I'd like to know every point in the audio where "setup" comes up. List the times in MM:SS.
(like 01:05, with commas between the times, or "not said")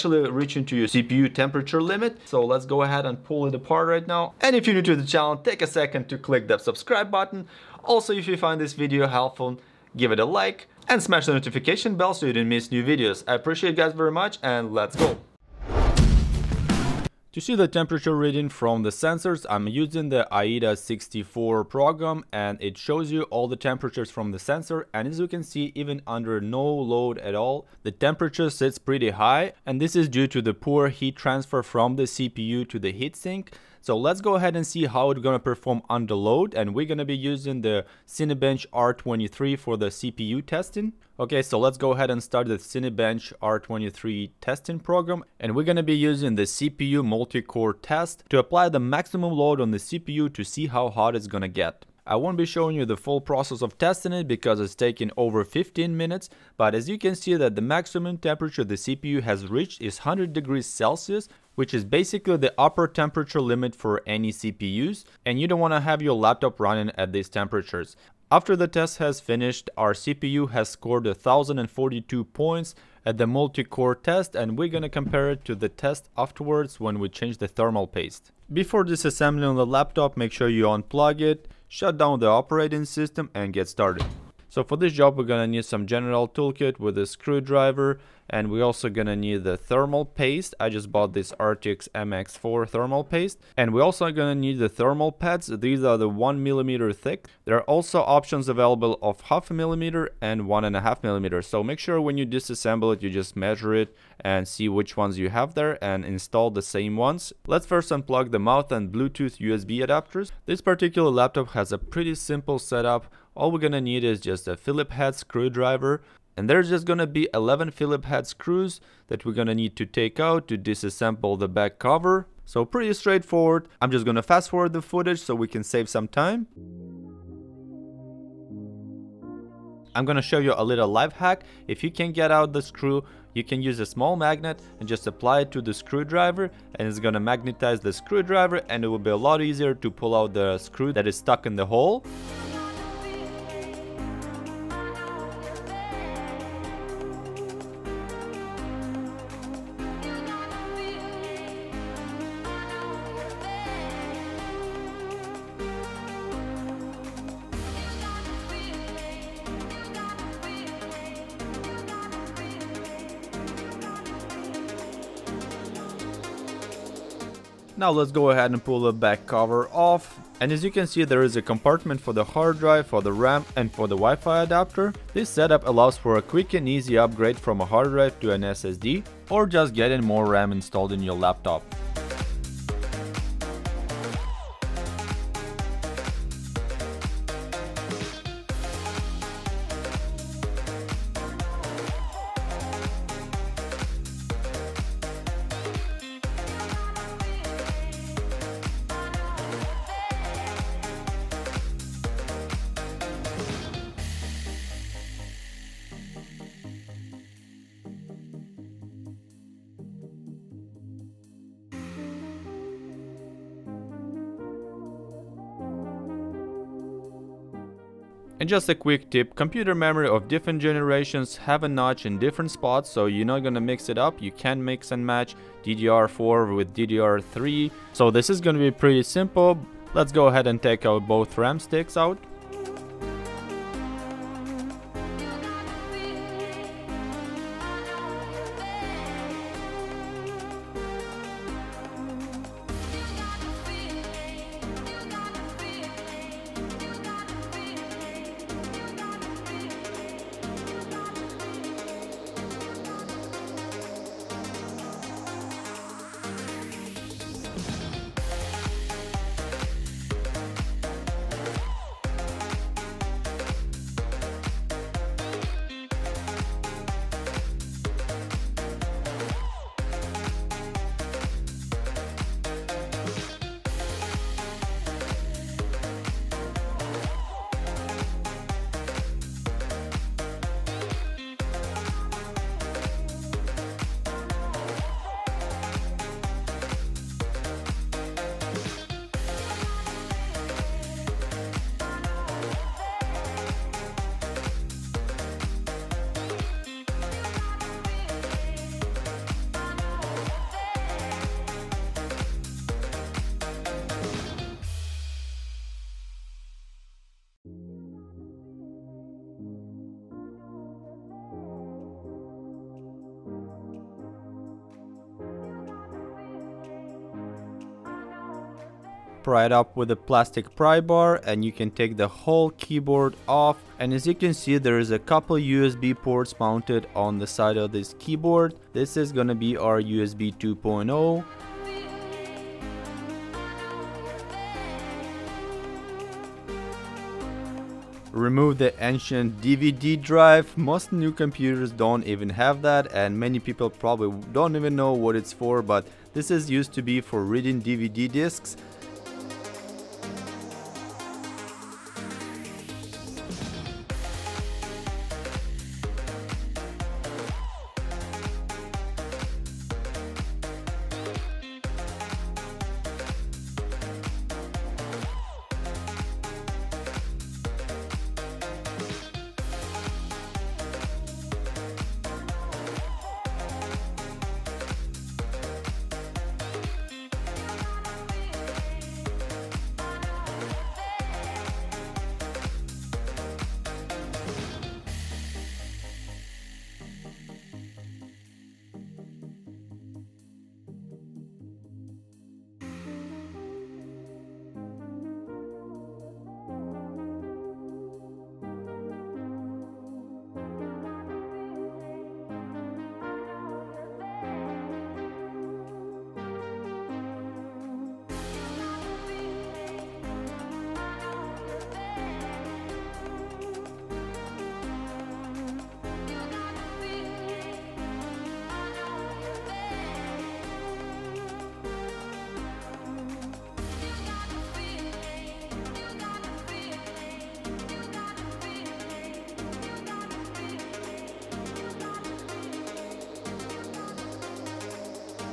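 01:52, 02:55.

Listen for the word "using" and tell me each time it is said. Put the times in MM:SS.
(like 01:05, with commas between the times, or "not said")
00:19, 00:37, 00:45.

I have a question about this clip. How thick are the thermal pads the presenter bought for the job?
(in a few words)
1 millimeter.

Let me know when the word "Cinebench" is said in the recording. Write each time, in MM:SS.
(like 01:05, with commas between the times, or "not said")
00:38, 00:42.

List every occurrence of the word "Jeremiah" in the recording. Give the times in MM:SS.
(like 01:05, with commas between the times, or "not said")
not said.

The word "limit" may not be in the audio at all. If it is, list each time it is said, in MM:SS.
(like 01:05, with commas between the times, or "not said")
00:01, 01:03.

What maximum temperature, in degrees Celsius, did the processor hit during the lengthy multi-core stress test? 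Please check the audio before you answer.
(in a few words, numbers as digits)
100.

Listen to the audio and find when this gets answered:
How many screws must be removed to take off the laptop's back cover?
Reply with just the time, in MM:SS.
01:57.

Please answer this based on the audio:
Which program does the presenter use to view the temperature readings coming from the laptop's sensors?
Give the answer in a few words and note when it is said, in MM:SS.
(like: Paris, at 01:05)
AIDA 64, at 00:20.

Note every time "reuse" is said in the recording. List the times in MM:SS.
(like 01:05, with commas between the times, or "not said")
not said.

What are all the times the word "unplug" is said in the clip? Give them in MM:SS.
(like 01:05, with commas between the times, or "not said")
01:20, 01:47.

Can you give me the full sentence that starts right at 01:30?
I just bought this Arctic MX4 thermal paste.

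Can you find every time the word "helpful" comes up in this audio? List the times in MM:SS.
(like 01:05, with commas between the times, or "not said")
00:09.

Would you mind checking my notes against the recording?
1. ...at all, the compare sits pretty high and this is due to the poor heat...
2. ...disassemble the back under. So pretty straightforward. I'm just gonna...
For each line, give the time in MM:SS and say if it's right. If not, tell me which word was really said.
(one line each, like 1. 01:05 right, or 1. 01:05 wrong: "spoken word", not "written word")
1. 00:27 wrong: "temperature", not "compare"
2. 02:00 wrong: "cover", not "under".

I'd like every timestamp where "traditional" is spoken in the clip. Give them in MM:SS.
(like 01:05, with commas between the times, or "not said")
not said.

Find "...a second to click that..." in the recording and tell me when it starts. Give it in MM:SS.
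00:05.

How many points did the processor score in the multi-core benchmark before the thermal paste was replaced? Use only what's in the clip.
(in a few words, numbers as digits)
1042.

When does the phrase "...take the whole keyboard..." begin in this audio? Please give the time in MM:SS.
05:21.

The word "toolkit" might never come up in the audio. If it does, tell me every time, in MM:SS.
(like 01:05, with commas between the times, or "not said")
01:26.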